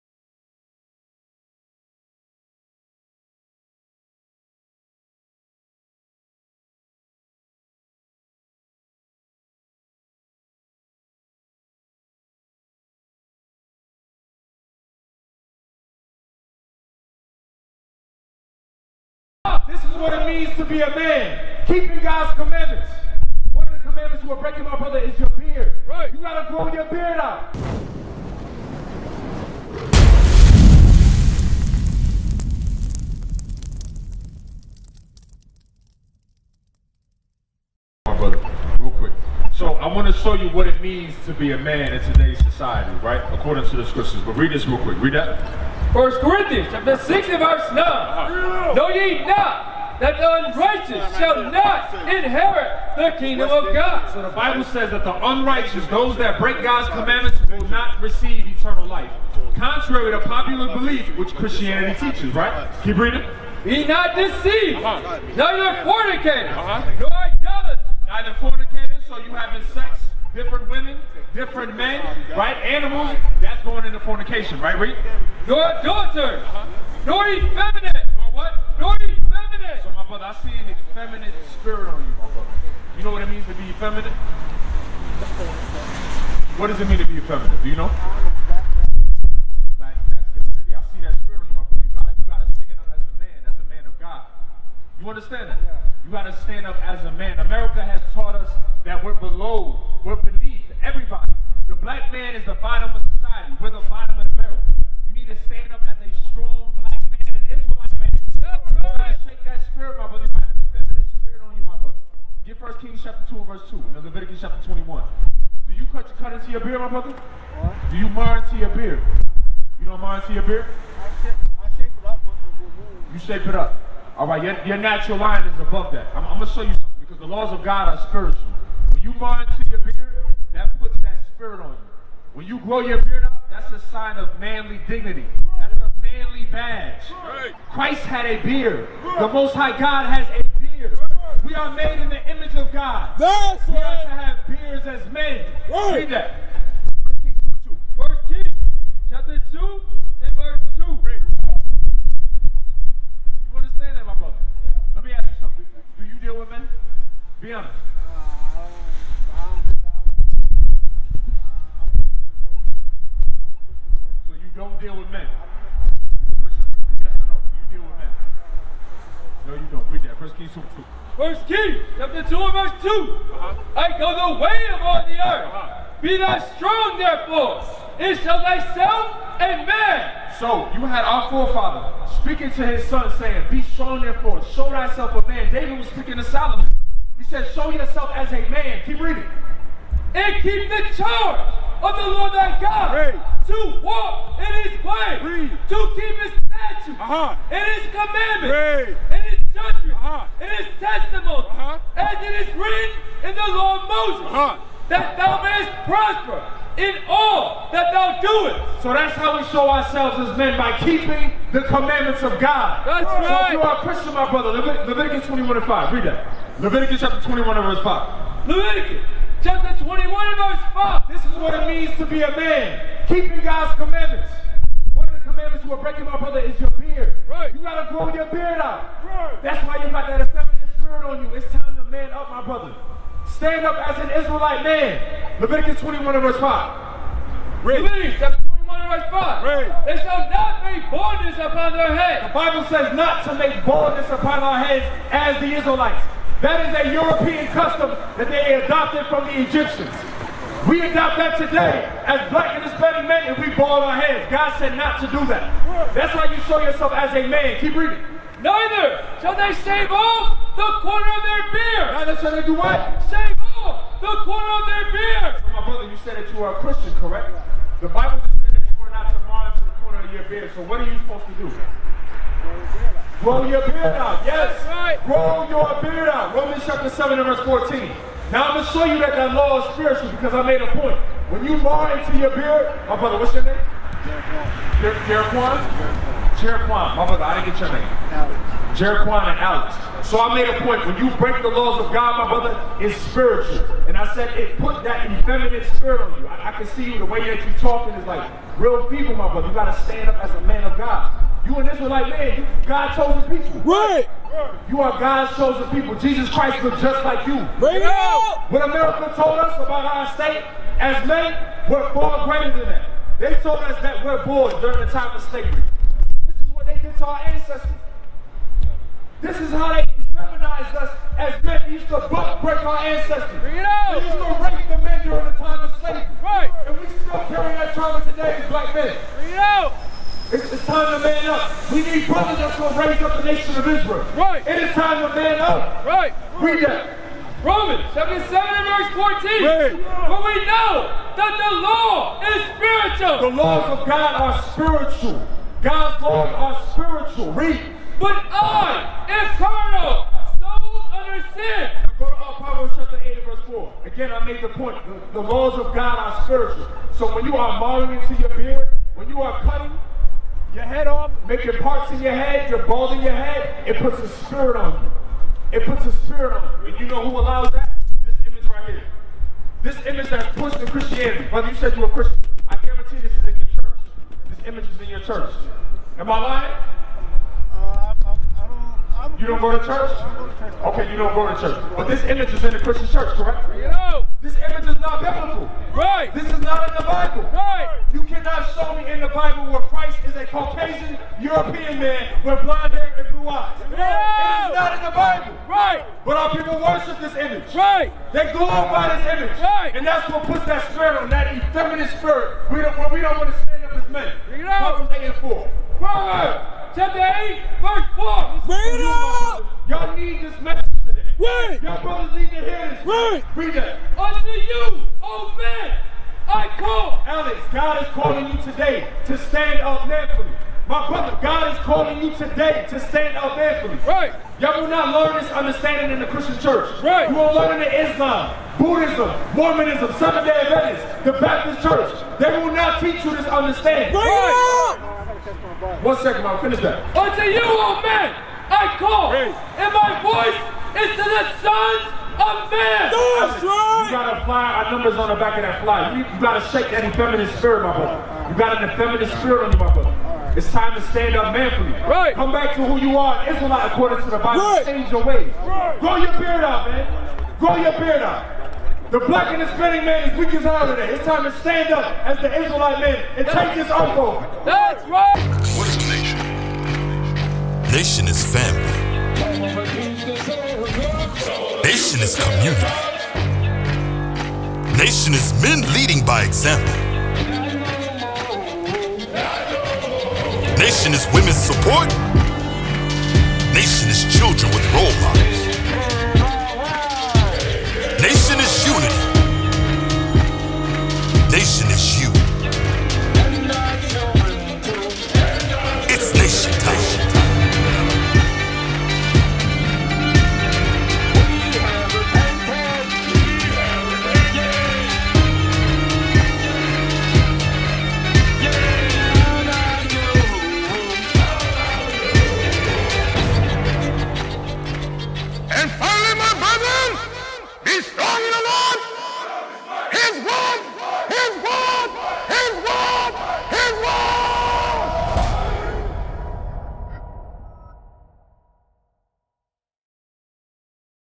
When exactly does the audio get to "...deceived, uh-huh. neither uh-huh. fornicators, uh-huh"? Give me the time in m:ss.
1:04.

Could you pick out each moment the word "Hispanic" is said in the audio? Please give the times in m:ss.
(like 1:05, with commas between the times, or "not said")
4:12, 7:39.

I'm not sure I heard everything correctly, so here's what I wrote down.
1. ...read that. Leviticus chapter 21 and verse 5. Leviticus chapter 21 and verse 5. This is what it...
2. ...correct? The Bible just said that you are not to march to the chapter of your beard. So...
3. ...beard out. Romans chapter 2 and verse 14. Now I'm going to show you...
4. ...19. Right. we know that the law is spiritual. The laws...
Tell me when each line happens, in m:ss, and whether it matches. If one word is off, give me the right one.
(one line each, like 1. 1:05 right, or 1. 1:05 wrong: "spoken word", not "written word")
1. 3:35 right
2. 4:26 wrong: "corner", not "chapter"
3. 4:35 wrong: "7", not "2"
4. 5:38 wrong: "14", not "19".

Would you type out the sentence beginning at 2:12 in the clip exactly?
When you grow your beard up, that's a sign of manly dignity.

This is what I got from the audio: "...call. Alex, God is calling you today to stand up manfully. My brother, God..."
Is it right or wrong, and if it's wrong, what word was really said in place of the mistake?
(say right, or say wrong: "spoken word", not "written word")
right.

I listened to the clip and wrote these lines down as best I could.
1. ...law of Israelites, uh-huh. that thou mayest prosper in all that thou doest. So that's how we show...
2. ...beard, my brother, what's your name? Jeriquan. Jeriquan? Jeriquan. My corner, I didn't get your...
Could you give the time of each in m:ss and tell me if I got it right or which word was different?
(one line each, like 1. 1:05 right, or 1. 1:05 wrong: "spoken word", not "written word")
1. 3:23 wrong: "Moses", not "Israelites"
2. 4:42 wrong: "brother", not "corner".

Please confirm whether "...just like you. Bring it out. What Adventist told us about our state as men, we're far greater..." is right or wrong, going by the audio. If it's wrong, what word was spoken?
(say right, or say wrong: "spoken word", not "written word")
wrong: "America", not "Adventist".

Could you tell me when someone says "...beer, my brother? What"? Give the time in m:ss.
1:56.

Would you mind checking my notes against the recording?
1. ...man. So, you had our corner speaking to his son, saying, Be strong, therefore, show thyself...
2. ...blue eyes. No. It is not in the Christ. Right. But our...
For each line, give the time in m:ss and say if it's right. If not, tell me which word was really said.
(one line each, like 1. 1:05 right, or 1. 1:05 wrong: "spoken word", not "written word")
1. 2:59 wrong: "forefather", not "corner"
2. 6:33 wrong: "Bible", not "Christ".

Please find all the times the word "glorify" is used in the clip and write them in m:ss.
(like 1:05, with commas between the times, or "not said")
6:38.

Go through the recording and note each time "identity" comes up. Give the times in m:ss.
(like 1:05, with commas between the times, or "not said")
not said.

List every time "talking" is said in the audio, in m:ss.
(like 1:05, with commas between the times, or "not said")
4:57.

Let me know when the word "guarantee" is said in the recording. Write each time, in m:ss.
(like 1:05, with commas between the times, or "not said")
6:12.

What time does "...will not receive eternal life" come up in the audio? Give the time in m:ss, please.
0:57.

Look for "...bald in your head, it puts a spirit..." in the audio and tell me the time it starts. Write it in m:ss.
6:02.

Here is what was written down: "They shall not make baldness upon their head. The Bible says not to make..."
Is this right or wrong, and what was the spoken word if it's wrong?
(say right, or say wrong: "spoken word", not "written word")
right.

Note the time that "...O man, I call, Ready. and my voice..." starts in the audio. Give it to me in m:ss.
7:17.